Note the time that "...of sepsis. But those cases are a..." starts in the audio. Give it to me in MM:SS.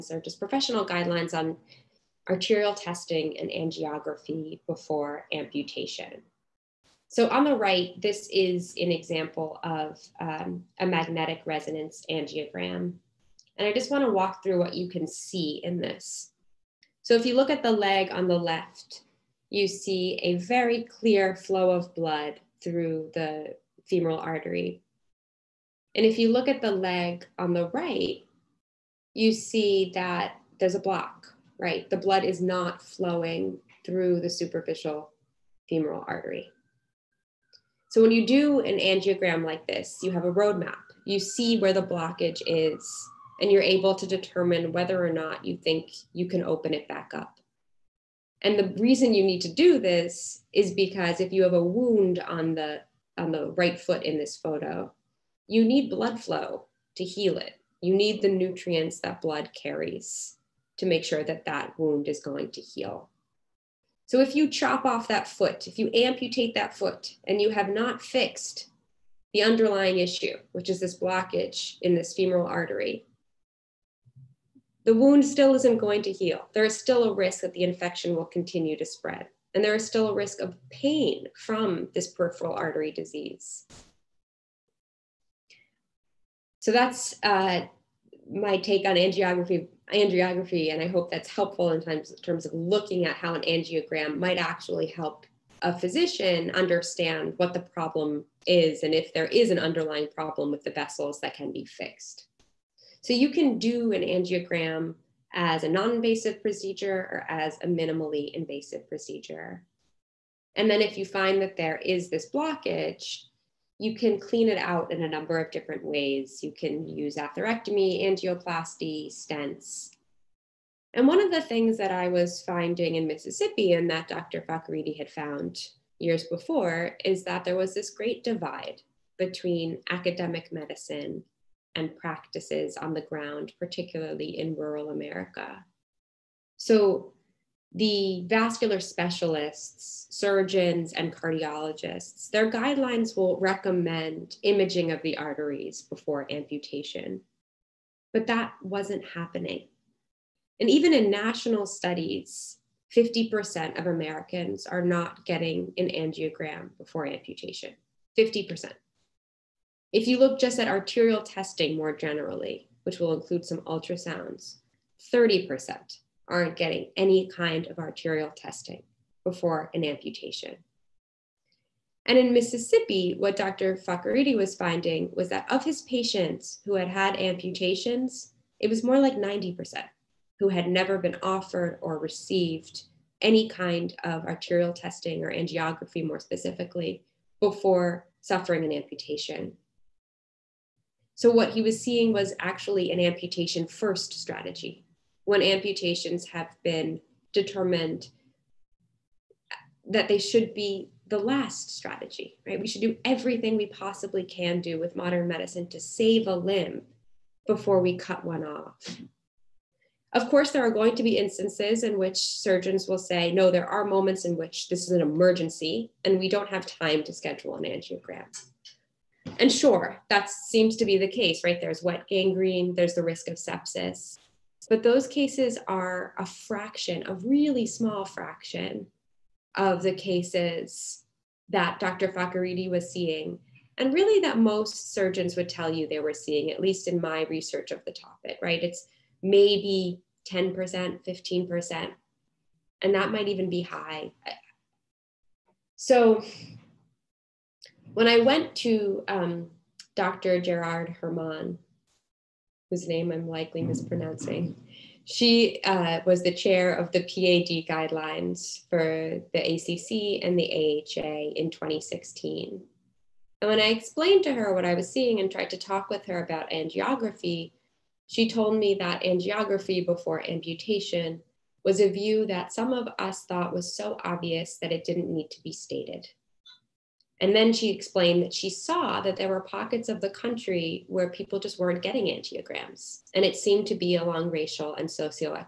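03:43.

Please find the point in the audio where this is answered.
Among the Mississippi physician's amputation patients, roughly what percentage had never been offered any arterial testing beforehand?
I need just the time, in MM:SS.
02:59.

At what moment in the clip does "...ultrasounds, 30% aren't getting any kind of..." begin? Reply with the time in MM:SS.
02:43.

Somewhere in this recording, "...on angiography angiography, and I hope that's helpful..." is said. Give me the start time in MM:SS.
01:28.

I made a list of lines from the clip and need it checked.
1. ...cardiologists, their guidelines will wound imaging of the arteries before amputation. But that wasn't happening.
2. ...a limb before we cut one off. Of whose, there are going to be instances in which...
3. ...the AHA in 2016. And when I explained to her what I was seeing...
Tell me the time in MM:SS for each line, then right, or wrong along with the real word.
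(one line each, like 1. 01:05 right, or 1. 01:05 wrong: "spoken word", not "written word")
1. 02:21 wrong: "recommend", not "wound"
2. 03:26 wrong: "course", not "whose"
3. 04:20 right.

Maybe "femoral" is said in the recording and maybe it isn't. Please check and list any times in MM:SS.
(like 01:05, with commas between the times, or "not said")
00:23, 00:35, 01:12.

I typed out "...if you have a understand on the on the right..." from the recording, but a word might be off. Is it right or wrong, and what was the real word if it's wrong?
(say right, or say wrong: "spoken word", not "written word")
wrong: "wound", not "understand".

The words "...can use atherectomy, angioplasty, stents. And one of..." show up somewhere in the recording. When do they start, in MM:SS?
01:56.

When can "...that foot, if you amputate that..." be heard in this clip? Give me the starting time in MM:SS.
01:05.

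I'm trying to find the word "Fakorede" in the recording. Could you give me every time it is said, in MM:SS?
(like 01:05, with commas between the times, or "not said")
02:04, 02:53, 03:52.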